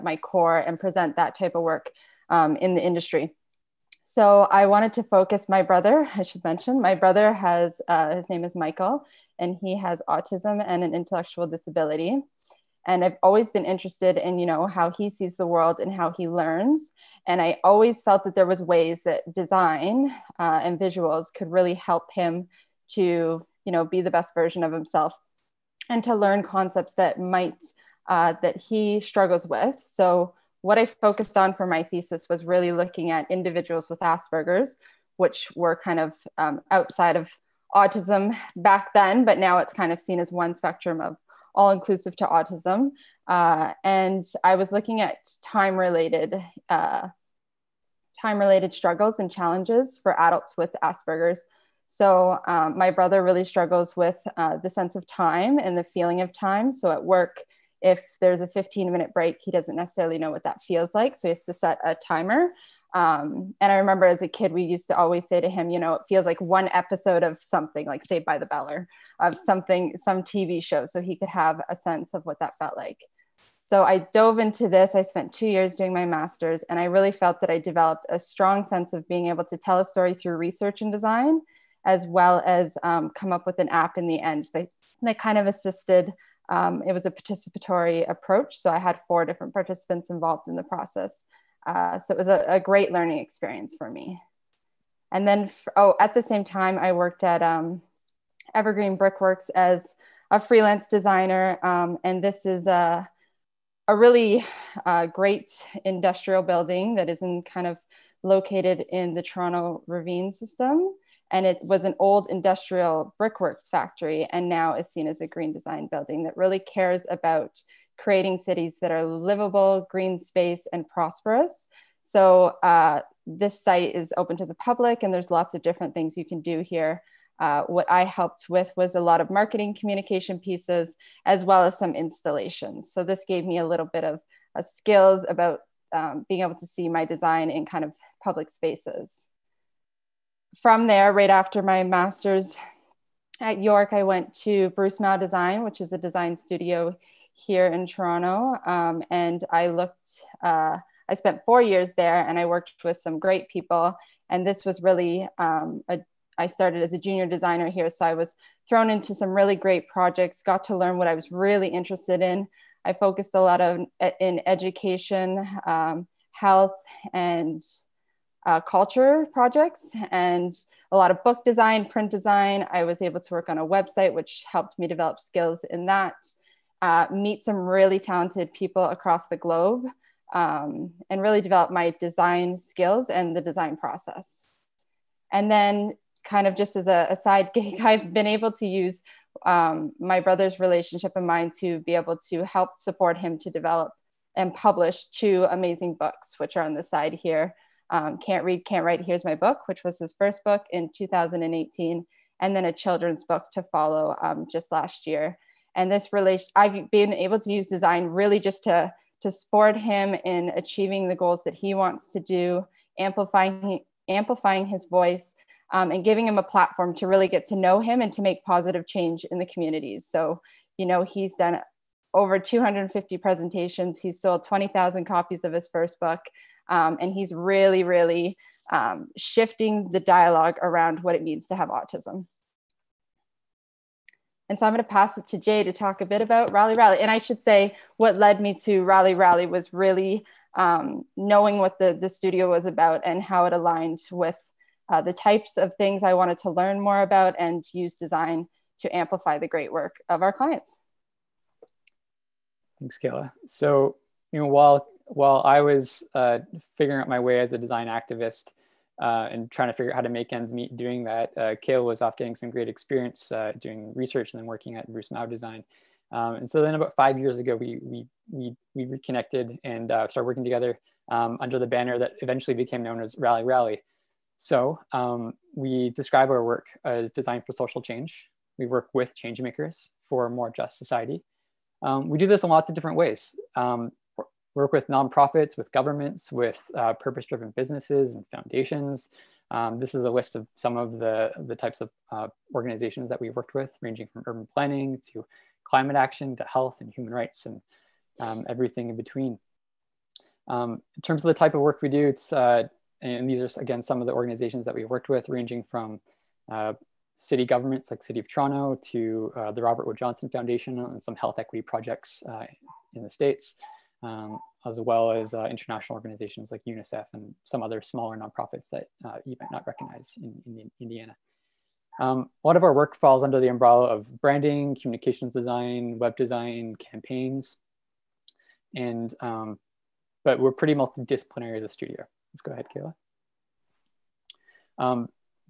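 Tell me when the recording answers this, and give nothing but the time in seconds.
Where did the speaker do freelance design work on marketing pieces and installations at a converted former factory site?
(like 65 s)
98 s.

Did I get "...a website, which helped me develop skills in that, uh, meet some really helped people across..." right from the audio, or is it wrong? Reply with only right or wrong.
wrong.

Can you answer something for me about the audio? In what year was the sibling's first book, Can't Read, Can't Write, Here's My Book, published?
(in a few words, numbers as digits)
2018.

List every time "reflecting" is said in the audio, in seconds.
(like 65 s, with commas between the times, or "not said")
not said.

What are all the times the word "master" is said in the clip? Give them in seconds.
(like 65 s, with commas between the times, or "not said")
76 s, 141 s.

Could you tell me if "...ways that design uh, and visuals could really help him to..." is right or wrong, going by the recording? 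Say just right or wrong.
right.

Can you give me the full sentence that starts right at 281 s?
Um, we do this in lots of different ways.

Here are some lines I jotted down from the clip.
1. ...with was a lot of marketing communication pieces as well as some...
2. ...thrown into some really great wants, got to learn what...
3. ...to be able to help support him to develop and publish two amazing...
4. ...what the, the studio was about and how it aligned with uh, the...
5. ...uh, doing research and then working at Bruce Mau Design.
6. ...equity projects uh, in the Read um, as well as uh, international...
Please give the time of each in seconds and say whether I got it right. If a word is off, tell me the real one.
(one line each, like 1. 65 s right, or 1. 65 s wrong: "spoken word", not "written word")
1. 128 s right
2. 158 s wrong: "projects", not "wants"
3. 191 s right
4. 241 s right
5. 263 s right
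6. 311 s wrong: "States", not "Read".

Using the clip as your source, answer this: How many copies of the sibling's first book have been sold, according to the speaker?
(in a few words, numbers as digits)
20,000.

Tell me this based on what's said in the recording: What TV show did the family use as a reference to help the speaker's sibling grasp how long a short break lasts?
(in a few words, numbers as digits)
Saved by the Bell.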